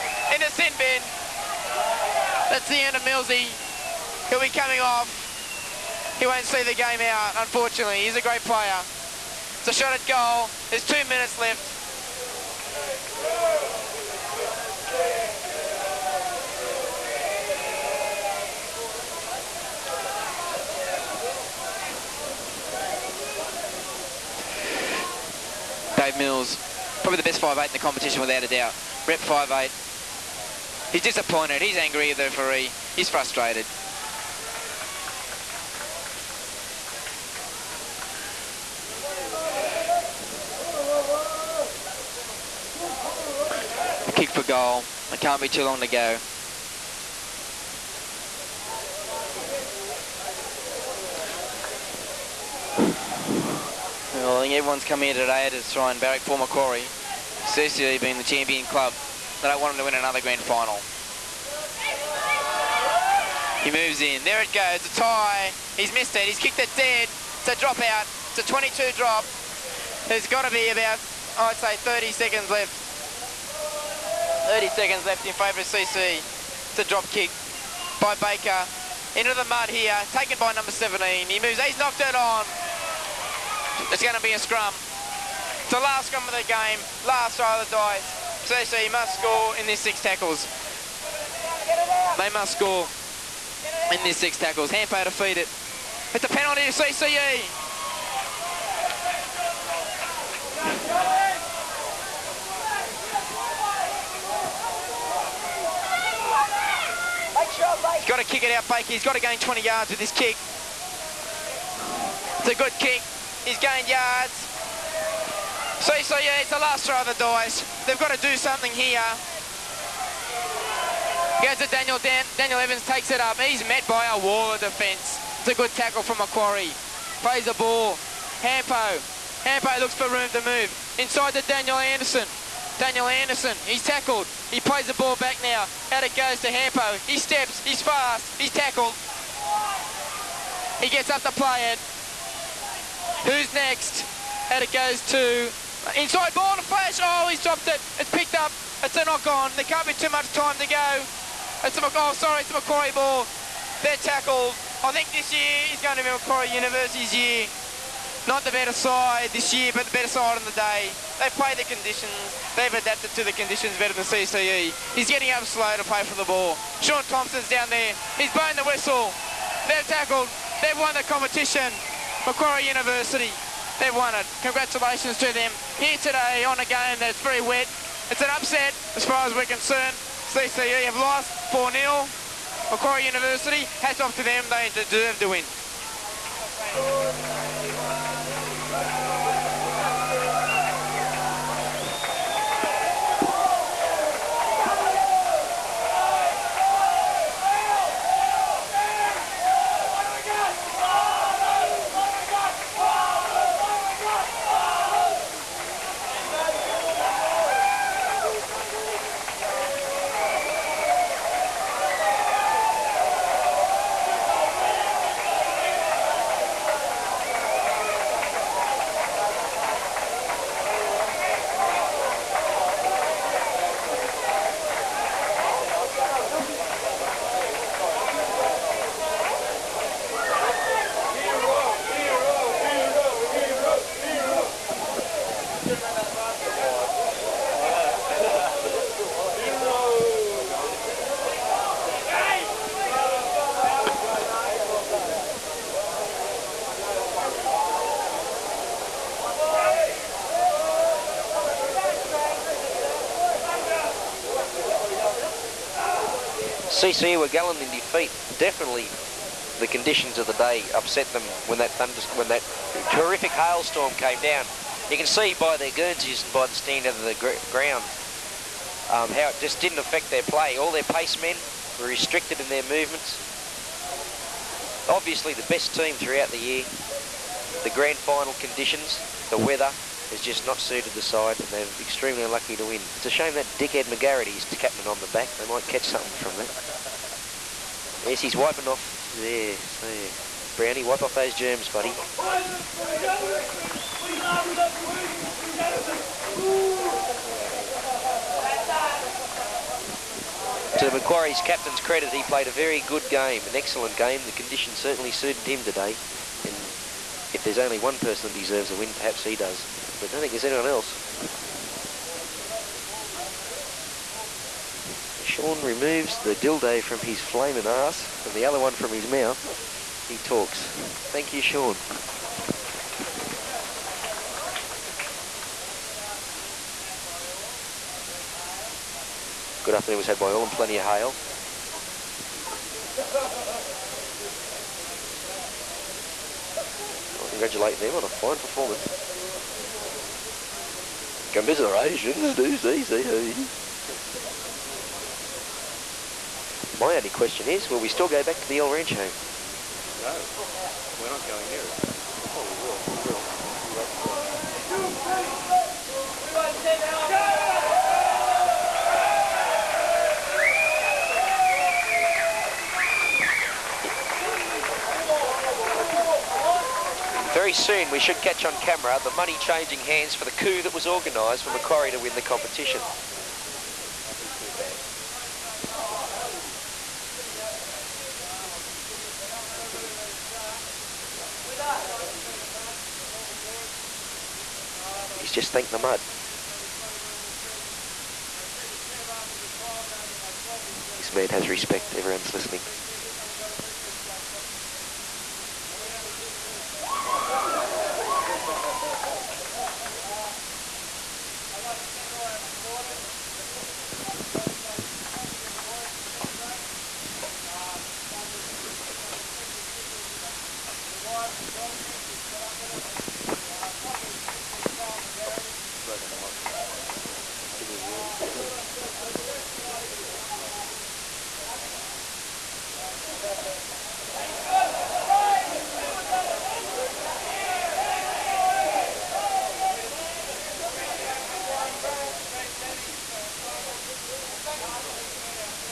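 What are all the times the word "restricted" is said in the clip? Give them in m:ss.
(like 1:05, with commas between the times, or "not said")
4:31.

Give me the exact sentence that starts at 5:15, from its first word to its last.
Sean removes the dildo from his flaming ass and the other one from his mouth.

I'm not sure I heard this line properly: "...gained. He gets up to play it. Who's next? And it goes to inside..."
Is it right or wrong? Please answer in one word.
wrong.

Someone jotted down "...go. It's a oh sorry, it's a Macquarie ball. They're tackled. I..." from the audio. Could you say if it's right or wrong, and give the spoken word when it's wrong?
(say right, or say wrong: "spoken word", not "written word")
right.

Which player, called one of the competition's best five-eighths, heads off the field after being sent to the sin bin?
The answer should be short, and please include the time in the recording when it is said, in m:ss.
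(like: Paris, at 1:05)
Dave Mills, at 0:26.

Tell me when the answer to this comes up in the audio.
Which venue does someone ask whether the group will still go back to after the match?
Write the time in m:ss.
5:48.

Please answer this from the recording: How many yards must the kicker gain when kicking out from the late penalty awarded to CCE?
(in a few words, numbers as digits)
20.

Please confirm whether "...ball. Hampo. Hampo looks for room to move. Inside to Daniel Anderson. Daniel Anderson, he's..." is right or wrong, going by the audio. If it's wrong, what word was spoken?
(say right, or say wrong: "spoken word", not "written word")
right.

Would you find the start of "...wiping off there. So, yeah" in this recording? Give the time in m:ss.
4:48.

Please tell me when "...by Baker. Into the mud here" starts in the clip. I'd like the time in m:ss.
1:18.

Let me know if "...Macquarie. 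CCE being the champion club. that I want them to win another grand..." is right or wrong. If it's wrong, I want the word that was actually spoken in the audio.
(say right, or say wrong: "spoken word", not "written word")
right.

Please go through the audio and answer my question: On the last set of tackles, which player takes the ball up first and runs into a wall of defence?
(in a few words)
Daniel Evans.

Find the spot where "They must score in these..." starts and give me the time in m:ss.
1:32.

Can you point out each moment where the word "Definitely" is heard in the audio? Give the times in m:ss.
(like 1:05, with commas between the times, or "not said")
4:18.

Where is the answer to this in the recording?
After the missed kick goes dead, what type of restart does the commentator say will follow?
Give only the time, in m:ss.
1:08.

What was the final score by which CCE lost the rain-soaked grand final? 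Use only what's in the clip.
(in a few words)
4-0.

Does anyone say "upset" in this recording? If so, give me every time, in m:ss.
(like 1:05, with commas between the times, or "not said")
2:58, 4:20.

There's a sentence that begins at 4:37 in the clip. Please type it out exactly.
The grand final conditions, the weather has just not suited the side, and they're extremely unlucky to win.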